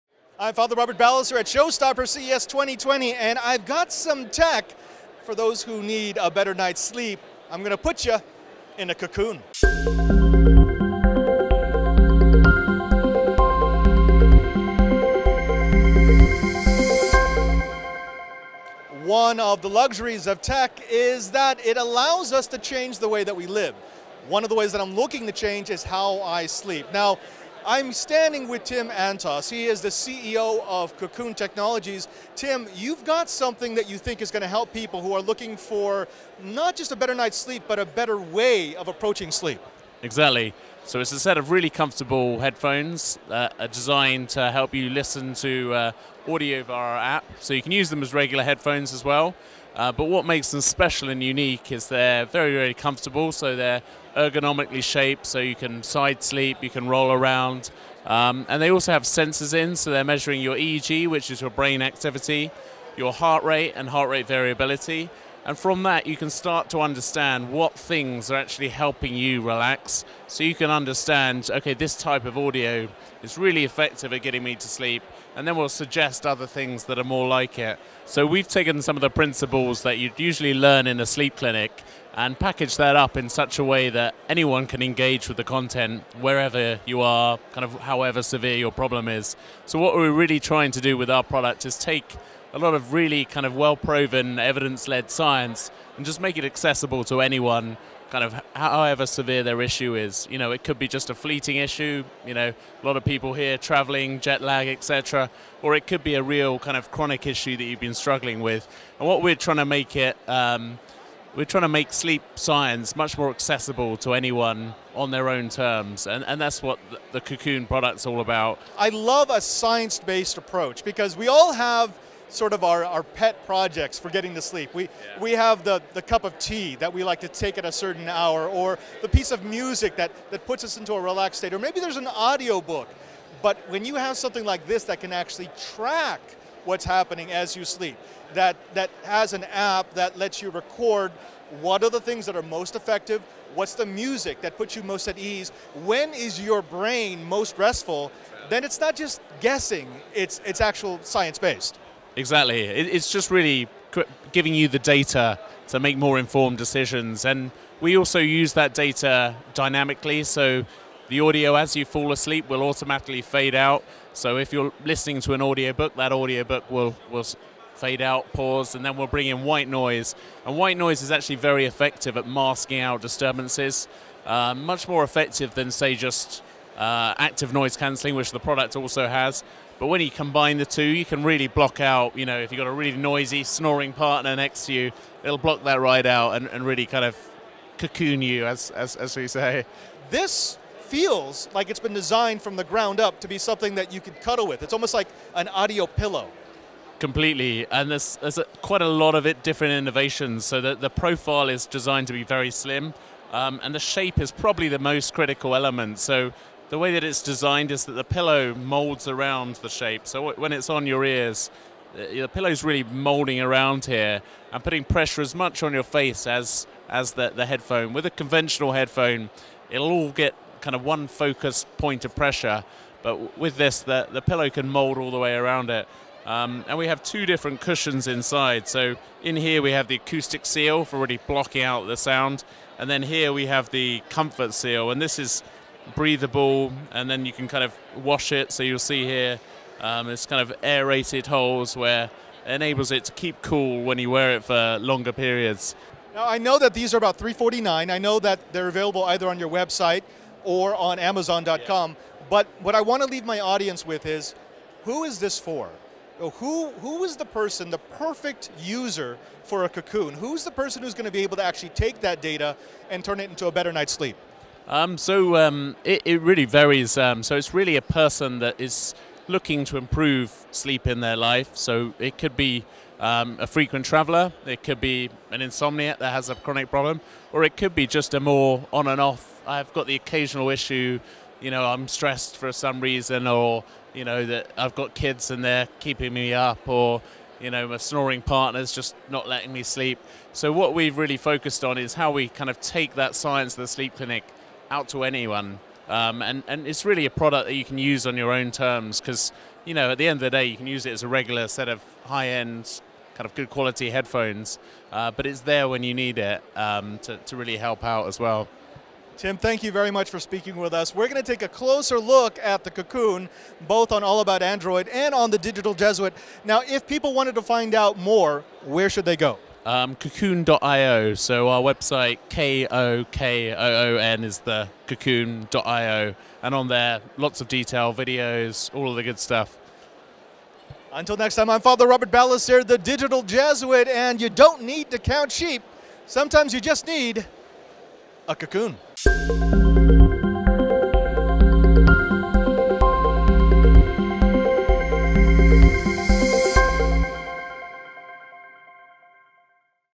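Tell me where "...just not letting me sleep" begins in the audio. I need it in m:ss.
4:48.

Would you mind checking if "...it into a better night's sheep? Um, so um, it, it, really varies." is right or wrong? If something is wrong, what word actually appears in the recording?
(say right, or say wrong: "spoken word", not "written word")
wrong: "sleep", not "sheep".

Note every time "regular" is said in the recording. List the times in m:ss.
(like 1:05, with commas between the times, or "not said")
0:48, 5:01.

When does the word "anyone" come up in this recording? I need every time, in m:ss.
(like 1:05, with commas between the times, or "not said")
1:24, 1:37, 1:54, 4:55.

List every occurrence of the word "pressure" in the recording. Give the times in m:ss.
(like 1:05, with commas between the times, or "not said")
3:34, 3:42.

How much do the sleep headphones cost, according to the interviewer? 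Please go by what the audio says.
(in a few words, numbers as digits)
$349.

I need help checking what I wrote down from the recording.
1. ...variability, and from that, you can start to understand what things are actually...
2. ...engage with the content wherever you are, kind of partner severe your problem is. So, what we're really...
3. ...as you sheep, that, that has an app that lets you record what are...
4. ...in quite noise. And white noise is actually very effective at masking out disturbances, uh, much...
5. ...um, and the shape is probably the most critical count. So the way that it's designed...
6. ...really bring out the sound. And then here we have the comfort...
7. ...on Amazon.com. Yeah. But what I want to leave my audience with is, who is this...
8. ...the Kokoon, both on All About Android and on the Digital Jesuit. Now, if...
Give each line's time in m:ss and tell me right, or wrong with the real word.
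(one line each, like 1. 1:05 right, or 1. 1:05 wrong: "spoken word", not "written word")
1. 1:04 right
2. 1:24 wrong: "however", not "partner"
3. 2:17 wrong: "sleep", not "sheep"
4. 2:49 wrong: "white", not "quite"
5. 3:23 wrong: "element", not "count"
6. 3:50 wrong: "blocking", not "bring"
7. 4:10 right
8. 5:12 right.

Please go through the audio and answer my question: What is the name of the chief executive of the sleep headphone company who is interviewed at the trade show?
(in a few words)
Tim Antos.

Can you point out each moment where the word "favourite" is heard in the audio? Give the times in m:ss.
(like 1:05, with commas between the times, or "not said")
not said.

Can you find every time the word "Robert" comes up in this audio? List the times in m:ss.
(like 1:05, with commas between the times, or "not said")
0:00, 5:31.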